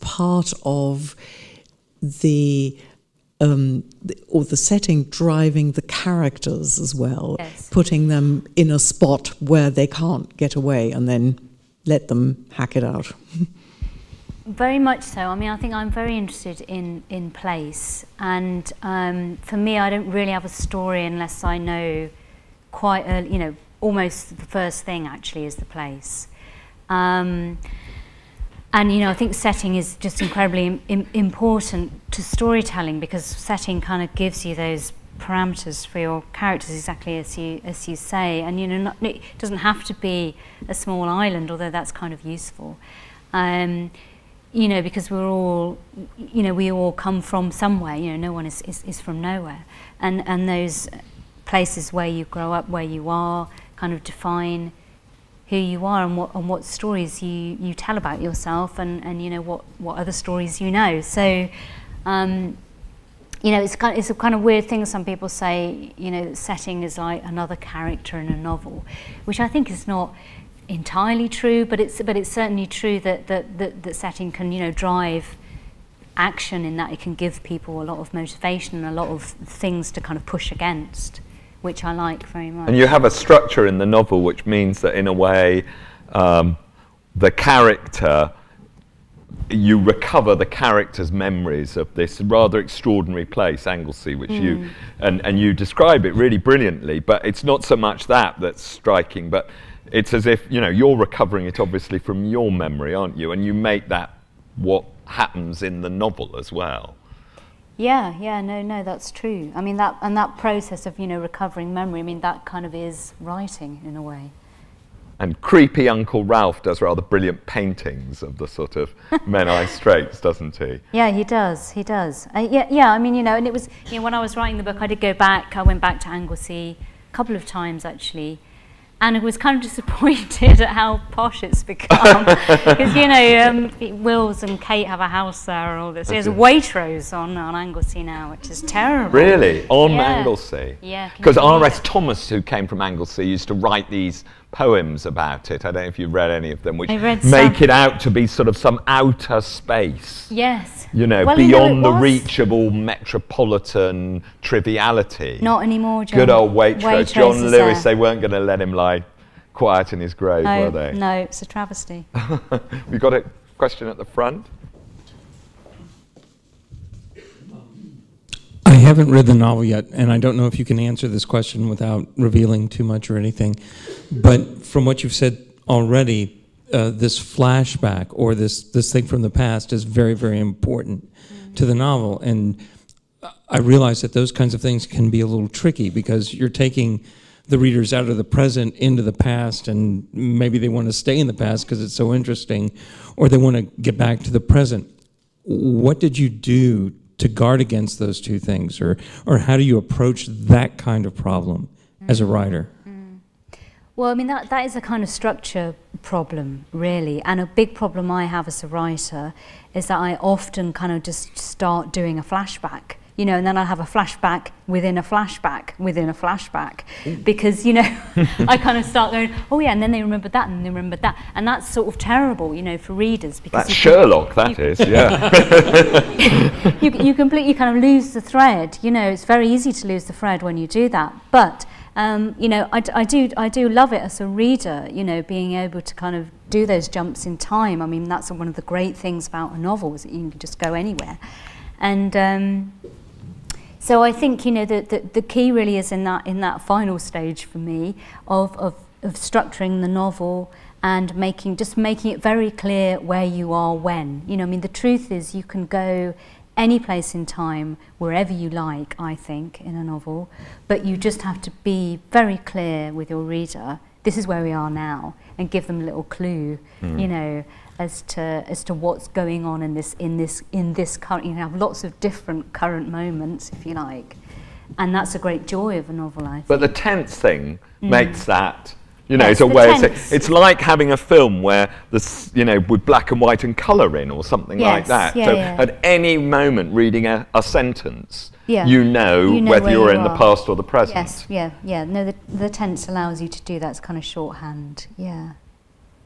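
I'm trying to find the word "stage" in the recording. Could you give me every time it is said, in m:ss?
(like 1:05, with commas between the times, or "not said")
4:06.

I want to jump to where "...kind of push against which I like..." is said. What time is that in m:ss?
1:19.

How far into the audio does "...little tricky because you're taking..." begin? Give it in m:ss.
3:05.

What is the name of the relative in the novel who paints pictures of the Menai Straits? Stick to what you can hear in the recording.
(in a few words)
Uncle Ralph.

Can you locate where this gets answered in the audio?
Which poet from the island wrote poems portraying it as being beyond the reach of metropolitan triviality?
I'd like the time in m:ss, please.
2:21.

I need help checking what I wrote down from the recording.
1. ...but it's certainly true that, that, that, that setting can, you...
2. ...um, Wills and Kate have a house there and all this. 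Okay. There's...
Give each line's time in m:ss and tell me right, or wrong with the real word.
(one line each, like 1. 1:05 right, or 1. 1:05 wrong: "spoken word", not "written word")
1. 1:12 right
2. 2:13 right.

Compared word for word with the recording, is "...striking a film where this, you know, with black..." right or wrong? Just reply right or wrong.
wrong.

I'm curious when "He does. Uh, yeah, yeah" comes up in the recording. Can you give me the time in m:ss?
2:01.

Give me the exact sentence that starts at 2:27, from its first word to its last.
it out to be sort of some outer space.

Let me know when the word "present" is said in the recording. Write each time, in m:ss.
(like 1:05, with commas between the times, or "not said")
3:08, 3:14, 4:50.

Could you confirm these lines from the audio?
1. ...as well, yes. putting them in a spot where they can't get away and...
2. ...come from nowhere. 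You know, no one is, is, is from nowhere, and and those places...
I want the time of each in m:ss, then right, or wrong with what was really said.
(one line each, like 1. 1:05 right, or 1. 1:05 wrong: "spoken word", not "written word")
1. 0:06 right
2. 0:46 wrong: "somewhere", not "nowhere".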